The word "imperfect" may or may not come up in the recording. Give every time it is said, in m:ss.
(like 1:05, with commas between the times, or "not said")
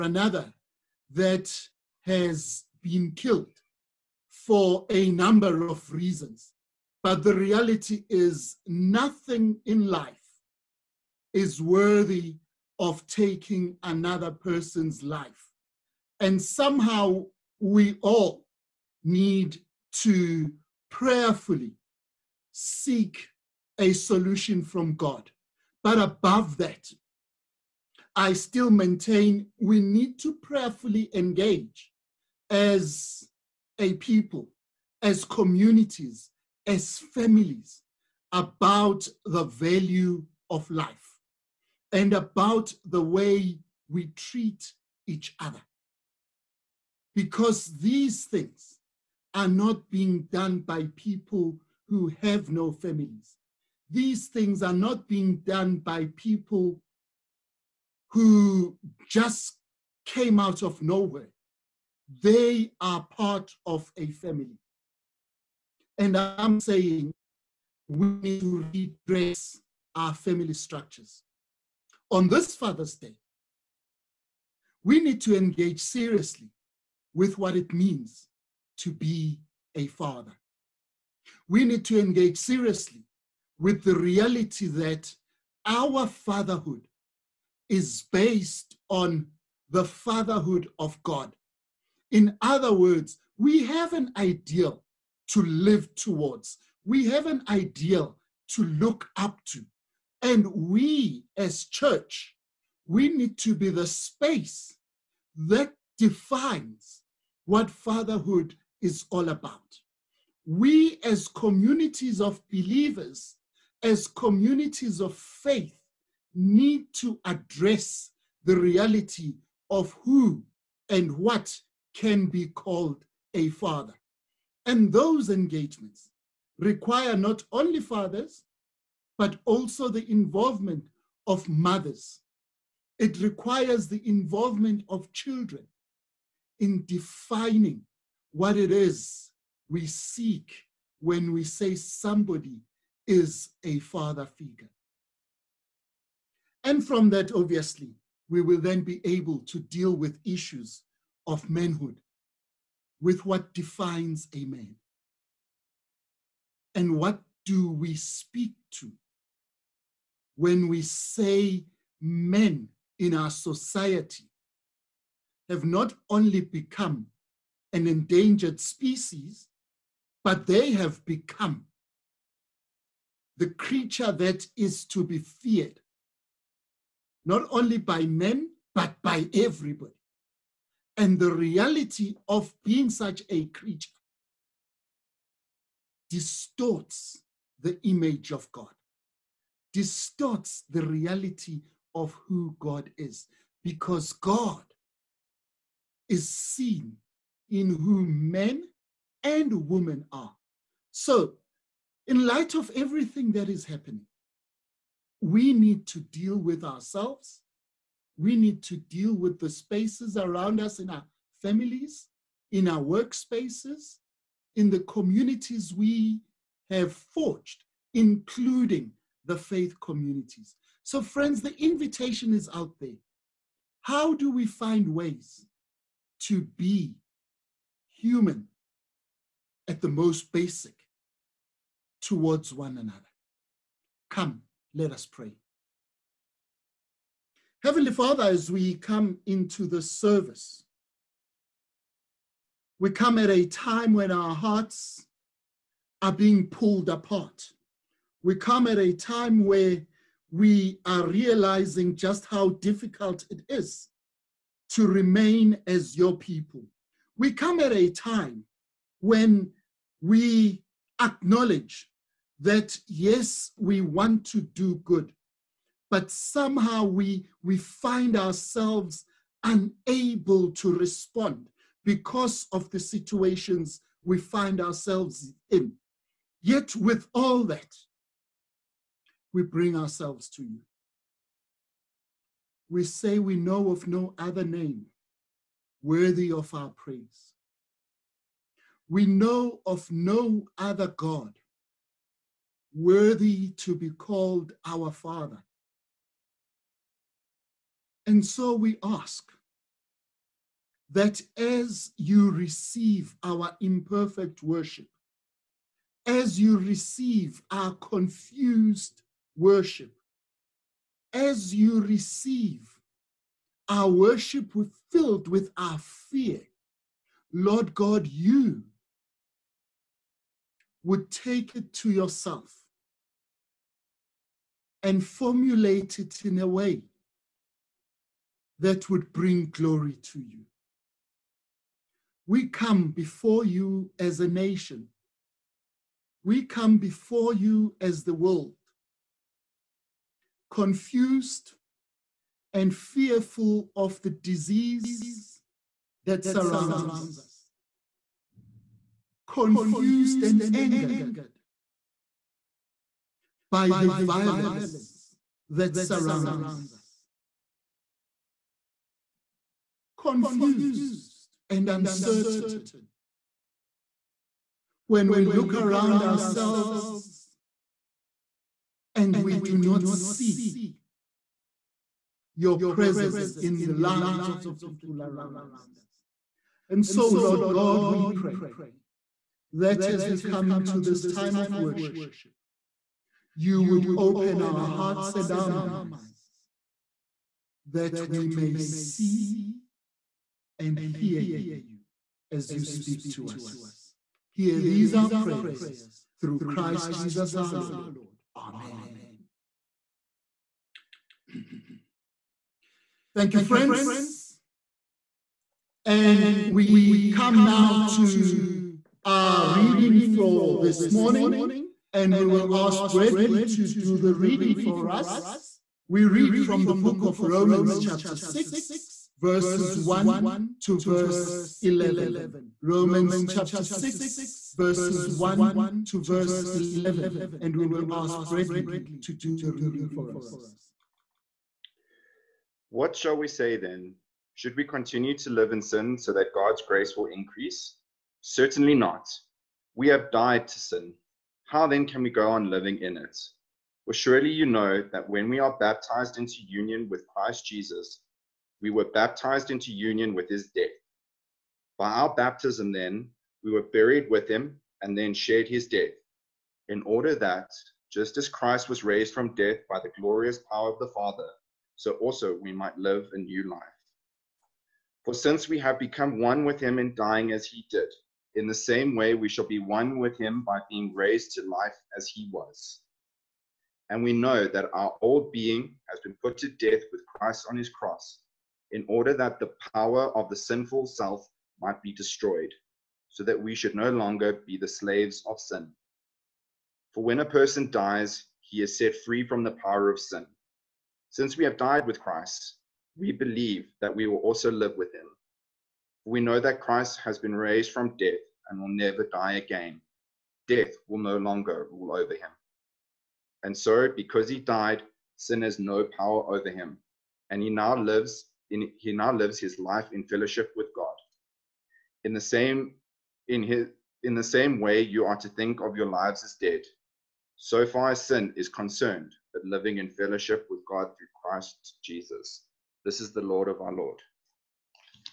5:03.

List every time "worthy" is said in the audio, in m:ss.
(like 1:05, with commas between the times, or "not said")
0:11, 4:45, 4:52.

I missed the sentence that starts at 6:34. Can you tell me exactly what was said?
Hear these our prayers through Christ Jesus our Lord.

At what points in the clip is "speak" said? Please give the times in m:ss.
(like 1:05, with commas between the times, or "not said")
2:37, 6:32.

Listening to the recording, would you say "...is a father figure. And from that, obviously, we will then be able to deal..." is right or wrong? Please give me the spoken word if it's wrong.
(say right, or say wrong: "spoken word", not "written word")
right.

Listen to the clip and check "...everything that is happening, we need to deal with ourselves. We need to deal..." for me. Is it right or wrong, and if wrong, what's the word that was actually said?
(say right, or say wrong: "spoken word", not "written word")
right.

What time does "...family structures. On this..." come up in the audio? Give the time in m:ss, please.
1:10.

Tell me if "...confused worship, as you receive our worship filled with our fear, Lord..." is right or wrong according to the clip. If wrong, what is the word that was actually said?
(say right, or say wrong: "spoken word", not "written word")
right.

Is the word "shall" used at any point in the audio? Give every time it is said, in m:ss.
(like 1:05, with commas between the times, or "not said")
7:12, 7:49.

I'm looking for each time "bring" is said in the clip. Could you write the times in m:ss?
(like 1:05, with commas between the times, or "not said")
4:39, 5:29.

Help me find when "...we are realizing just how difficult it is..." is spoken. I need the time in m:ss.
4:10.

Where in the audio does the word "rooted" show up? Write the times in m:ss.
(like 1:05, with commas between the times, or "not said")
not said.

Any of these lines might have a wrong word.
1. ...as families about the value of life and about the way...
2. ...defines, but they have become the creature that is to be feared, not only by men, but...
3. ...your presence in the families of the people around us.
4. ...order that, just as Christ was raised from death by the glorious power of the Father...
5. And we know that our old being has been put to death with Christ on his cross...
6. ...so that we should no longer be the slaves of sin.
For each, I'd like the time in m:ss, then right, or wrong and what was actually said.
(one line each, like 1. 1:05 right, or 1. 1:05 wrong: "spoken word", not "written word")
1. 0:36 right
2. 2:48 wrong: "species", not "defines"
3. 6:12 wrong: "lives", not "families"
4. 7:36 right
5. 7:53 right
6. 8:03 right.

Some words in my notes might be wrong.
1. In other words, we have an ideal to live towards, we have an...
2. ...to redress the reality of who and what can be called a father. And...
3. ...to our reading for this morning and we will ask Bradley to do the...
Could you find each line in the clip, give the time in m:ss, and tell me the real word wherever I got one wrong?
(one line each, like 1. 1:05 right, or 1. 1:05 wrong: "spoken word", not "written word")
1. 1:32 right
2. 1:56 wrong: "address", not "redress"
3. 6:47 right.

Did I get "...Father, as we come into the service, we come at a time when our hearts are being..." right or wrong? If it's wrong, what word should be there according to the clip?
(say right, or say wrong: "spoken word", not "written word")
right.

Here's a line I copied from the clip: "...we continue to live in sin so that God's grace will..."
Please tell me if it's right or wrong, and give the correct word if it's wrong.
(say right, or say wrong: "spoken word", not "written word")
right.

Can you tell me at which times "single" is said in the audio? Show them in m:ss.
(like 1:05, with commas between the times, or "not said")
not said.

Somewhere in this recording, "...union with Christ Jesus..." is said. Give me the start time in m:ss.
7:26.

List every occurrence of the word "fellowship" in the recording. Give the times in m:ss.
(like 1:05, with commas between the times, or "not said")
8:30, 8:39.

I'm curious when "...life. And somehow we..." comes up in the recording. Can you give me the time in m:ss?
0:15.